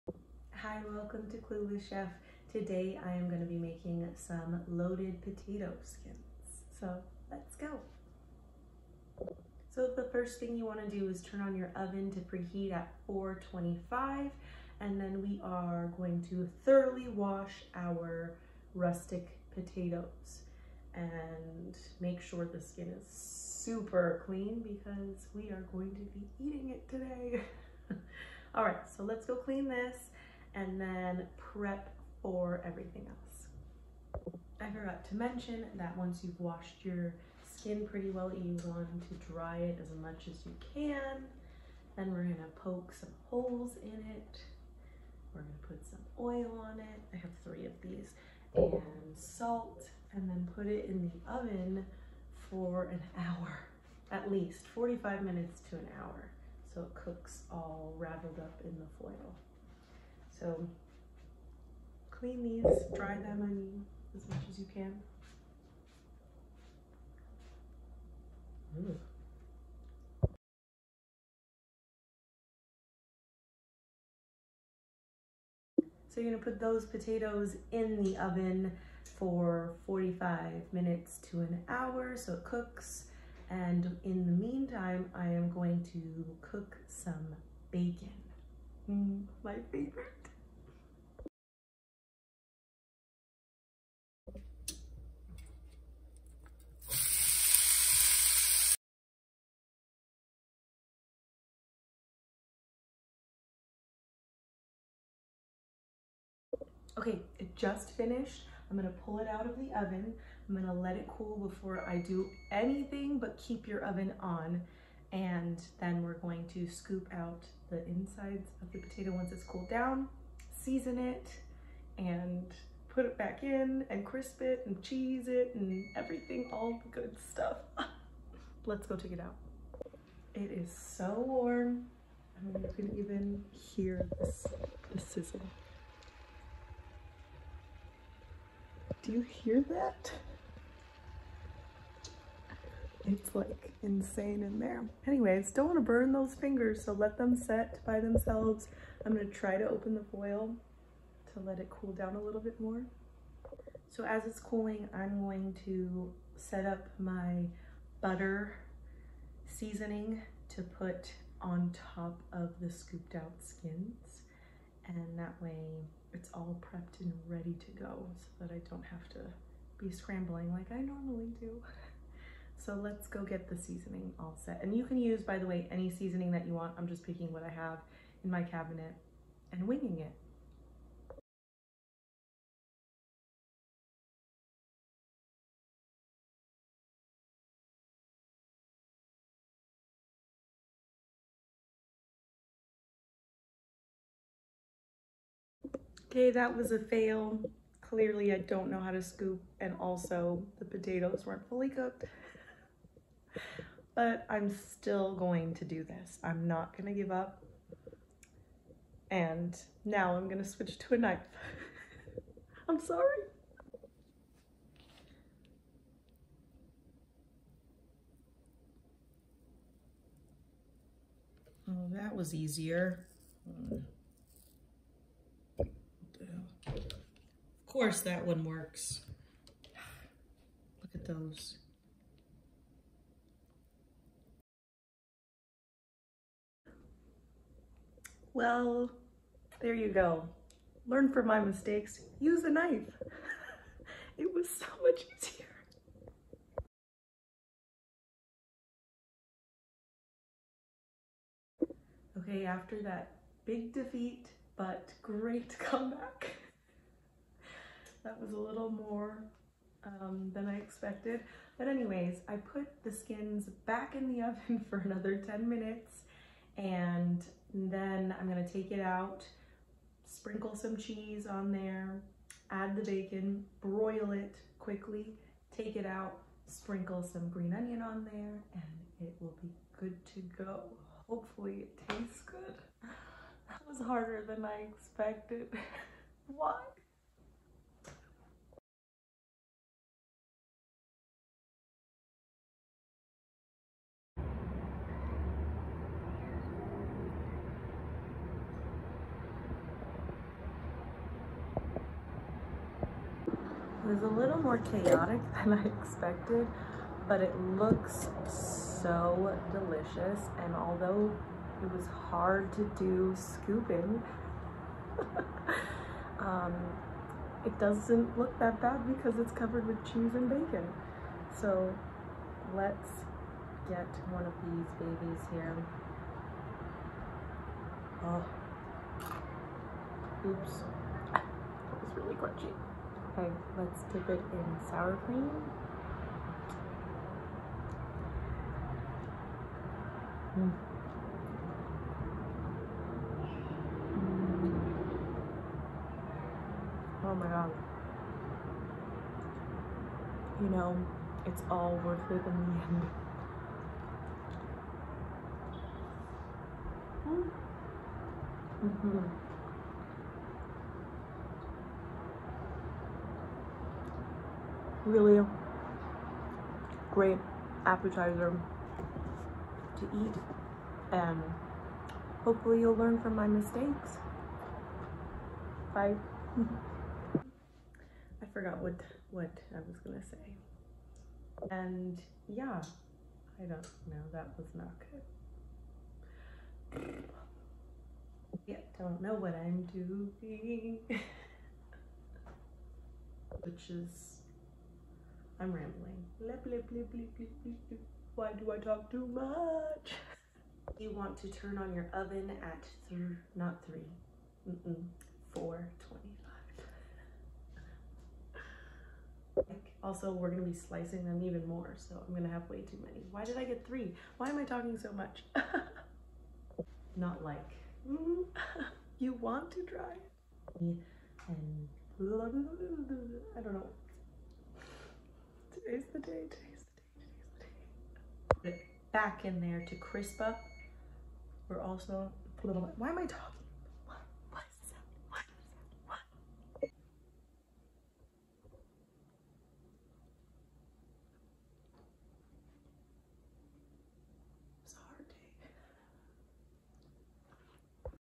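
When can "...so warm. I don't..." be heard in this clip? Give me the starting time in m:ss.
2:10.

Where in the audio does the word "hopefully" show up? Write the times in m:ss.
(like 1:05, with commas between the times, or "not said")
4:41, 6:12.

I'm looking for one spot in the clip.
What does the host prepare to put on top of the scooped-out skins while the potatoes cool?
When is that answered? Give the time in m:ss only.
2:38.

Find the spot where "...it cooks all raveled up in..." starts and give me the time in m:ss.
0:56.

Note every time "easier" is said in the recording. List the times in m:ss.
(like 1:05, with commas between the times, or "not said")
3:42, 4:05.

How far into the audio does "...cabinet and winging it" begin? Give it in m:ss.
2:58.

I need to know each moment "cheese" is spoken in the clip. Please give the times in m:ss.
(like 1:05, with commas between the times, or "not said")
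2:04, 4:30, 5:19.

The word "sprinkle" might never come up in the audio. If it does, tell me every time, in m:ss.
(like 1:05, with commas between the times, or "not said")
4:30, 4:36.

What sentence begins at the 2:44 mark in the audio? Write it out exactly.
And that way it's all prepped and ready to go so that I don't have to be scrambling like I normally do.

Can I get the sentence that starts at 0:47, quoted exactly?
I have three of these oh.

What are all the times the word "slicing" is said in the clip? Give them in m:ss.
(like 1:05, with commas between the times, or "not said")
6:50.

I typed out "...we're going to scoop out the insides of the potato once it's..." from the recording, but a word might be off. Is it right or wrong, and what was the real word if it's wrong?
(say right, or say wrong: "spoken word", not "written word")
right.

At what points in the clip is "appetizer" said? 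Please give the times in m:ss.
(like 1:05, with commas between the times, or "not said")
6:07.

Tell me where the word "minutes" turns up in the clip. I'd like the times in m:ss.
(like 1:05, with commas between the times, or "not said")
0:55, 1:20, 4:25.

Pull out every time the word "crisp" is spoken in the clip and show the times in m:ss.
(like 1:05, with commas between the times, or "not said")
2:04, 7:09.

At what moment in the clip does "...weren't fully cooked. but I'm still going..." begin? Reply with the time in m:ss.
3:21.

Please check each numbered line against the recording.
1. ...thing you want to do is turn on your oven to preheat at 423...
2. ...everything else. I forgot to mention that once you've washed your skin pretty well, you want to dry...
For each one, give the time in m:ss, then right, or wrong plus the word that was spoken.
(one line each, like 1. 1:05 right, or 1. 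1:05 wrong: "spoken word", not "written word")
1. 0:10 wrong: "425", not "423"
2. 0:32 right.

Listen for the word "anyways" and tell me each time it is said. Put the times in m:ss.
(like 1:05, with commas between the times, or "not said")
2:25, 4:21.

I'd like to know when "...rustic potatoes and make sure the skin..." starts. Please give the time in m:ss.
0:18.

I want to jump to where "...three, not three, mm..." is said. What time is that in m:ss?
6:42.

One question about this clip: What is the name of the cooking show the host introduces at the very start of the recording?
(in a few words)
Clueless Chef.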